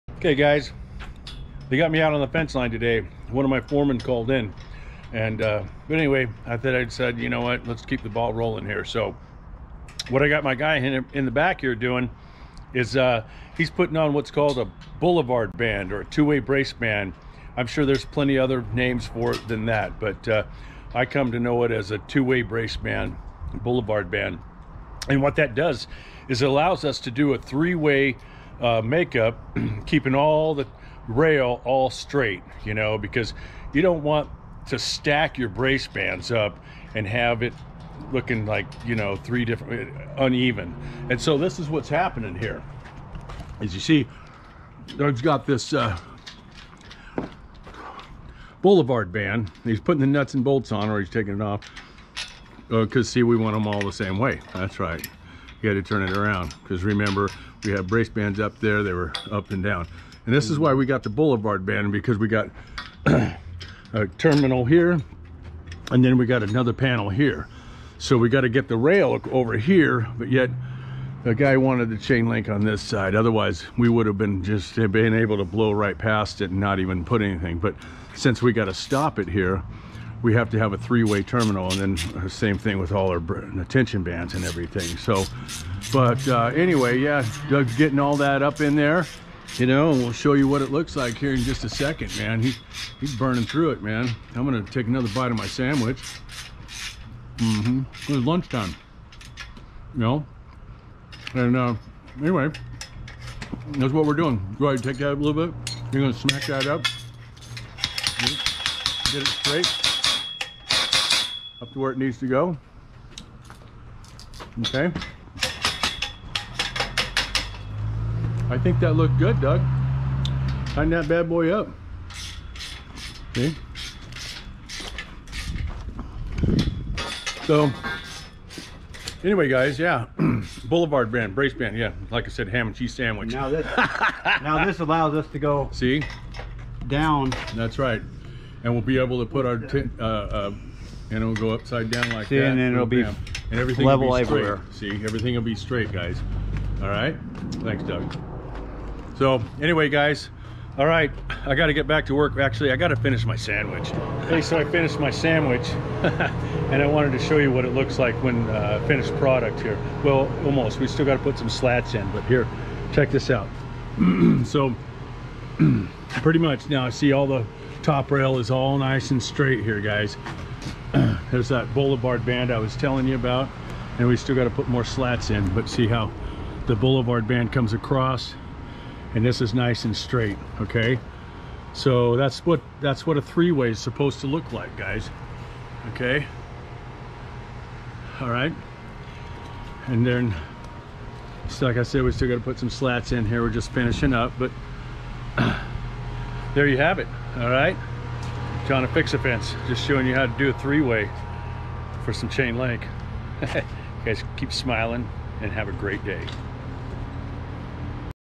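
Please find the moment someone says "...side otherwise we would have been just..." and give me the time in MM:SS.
01:12.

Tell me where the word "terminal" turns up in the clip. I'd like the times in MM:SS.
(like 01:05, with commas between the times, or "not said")
01:04, 01:21.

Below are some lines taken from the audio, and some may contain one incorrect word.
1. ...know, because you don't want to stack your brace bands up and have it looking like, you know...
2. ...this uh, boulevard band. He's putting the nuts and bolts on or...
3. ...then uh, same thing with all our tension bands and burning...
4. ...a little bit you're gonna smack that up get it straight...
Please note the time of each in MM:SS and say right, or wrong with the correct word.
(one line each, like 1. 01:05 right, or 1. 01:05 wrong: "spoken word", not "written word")
1. 00:32 right
2. 00:45 right
3. 01:21 wrong: "everything", not "burning"
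4. 01:45 right.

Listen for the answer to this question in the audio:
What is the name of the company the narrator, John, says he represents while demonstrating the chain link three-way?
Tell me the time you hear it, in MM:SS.
03:18.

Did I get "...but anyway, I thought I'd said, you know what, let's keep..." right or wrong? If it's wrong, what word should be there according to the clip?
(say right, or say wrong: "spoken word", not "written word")
right.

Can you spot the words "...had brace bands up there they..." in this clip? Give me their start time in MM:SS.
00:57.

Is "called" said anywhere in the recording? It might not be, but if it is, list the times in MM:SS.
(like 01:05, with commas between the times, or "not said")
00:03, 00:14.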